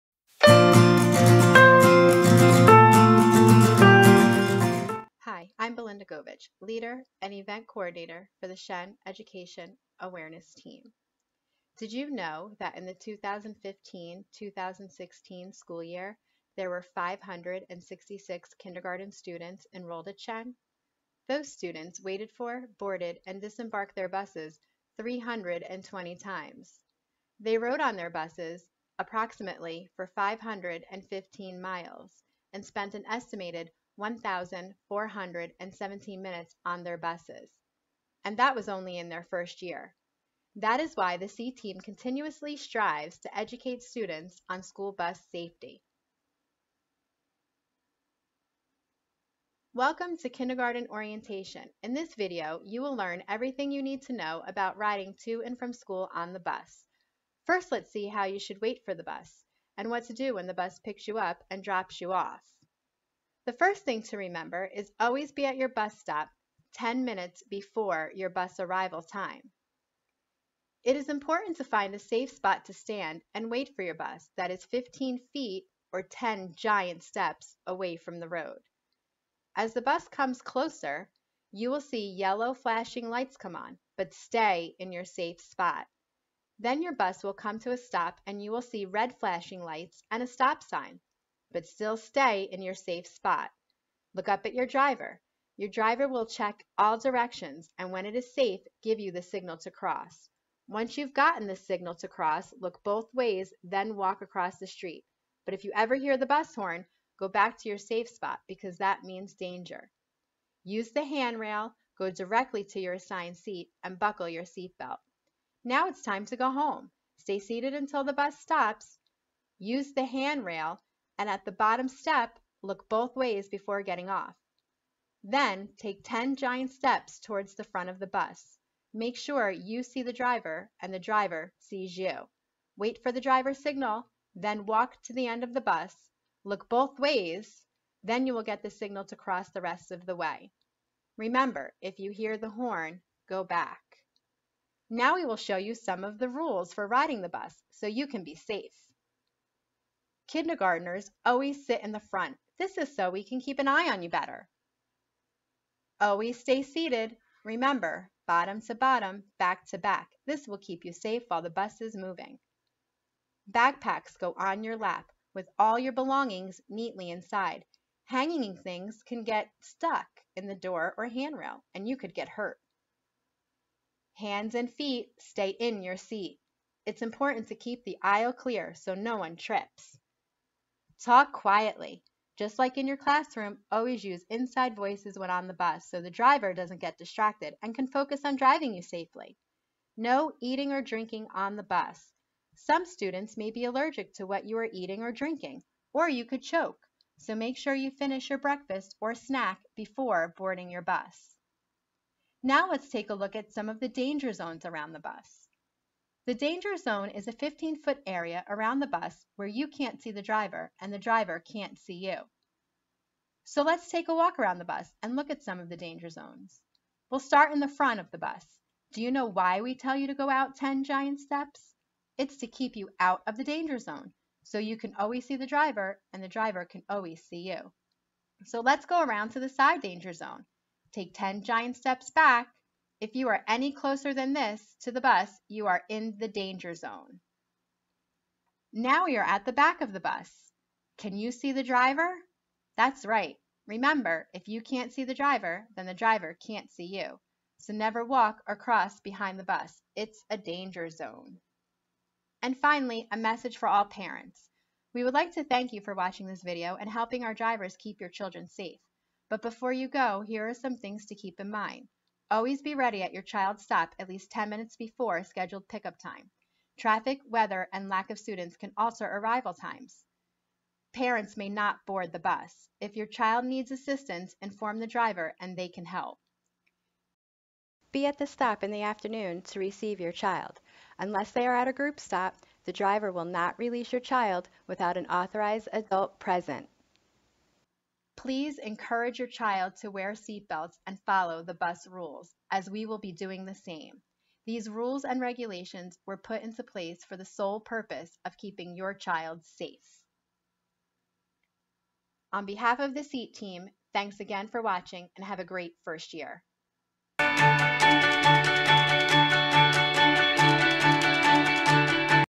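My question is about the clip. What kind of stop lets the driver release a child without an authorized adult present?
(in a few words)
group stop.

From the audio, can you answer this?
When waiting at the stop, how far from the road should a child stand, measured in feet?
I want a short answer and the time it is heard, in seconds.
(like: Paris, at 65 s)
15 feet, at 74 s.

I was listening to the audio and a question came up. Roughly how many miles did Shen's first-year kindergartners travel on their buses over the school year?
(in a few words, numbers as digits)
515.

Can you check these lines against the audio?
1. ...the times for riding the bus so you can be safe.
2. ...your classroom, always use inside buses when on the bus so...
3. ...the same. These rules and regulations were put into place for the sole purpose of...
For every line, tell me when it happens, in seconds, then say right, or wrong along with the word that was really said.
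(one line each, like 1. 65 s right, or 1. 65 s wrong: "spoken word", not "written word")
1. 146 s wrong: "rules", not "times"
2. 182 s wrong: "voices", not "buses"
3. 293 s right.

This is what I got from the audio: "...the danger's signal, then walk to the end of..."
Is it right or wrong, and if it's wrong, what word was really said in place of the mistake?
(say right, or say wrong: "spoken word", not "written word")
wrong: "driver", not "danger".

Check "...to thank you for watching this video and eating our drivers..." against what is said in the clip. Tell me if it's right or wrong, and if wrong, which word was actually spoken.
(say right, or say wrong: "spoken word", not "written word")
wrong: "helping", not "eating".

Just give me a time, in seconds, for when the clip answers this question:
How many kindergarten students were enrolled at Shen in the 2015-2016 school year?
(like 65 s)
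16 s.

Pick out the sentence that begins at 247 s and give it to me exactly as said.
So never walk or cross behind the bus.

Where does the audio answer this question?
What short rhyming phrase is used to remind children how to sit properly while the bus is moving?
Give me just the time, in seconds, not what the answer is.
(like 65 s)
158 s.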